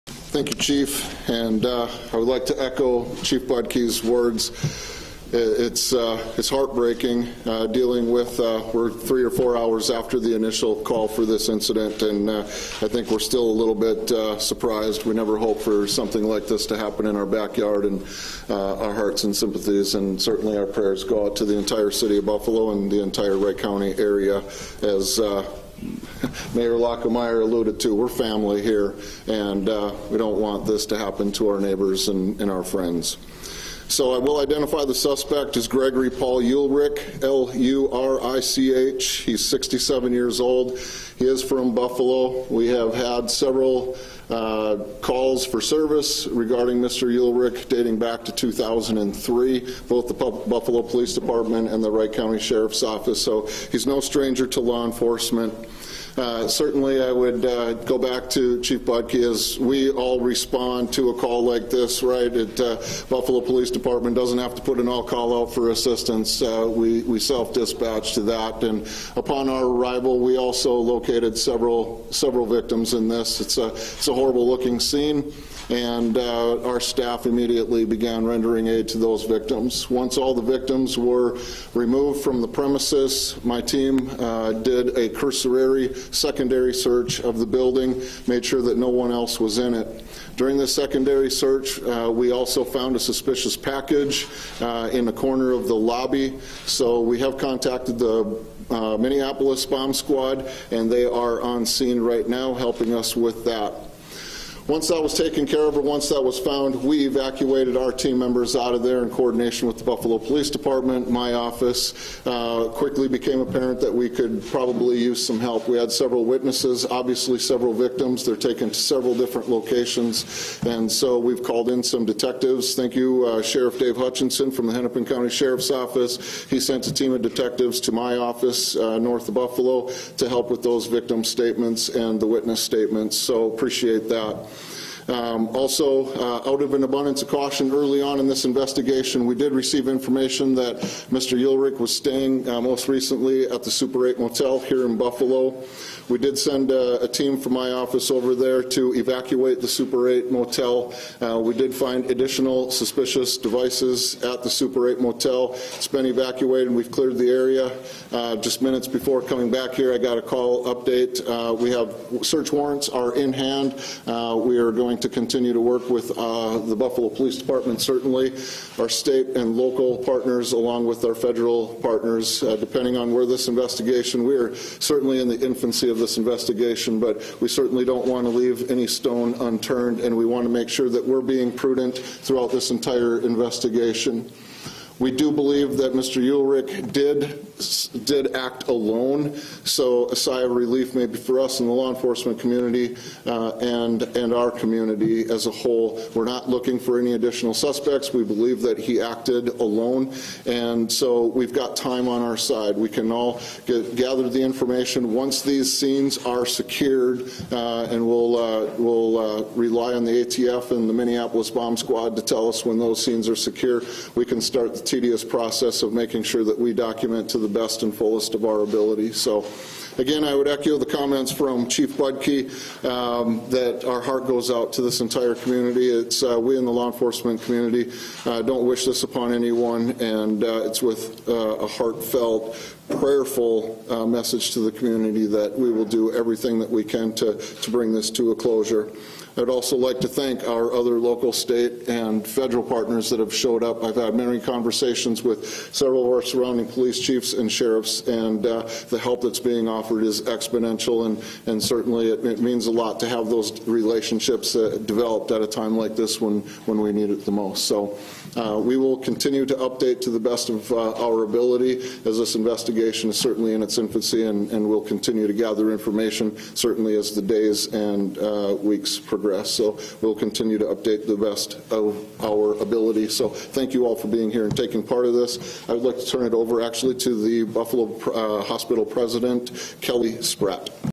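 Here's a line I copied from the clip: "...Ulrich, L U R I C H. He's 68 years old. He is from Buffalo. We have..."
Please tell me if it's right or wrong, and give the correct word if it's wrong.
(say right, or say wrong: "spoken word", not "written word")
wrong: "67", not "68".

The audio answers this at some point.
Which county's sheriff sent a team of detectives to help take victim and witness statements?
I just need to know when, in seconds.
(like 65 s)
124 s.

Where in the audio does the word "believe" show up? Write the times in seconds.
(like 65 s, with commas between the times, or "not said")
185 s, 198 s.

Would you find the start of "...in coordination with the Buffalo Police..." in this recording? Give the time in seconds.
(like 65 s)
109 s.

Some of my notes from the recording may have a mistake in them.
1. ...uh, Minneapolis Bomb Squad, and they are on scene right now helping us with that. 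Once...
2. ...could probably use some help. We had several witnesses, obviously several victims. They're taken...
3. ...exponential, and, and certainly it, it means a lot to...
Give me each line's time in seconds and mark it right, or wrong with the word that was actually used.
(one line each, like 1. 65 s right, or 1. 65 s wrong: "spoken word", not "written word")
1. 98 s right
2. 114 s right
3. 250 s right.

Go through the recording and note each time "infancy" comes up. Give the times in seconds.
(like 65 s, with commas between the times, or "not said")
175 s, 263 s.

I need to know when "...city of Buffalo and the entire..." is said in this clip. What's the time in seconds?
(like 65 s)
21 s.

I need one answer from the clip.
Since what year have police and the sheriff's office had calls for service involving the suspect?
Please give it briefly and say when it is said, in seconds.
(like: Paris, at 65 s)
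2003, at 48 s.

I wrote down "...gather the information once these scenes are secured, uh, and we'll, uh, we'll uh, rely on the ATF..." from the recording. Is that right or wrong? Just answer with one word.
right.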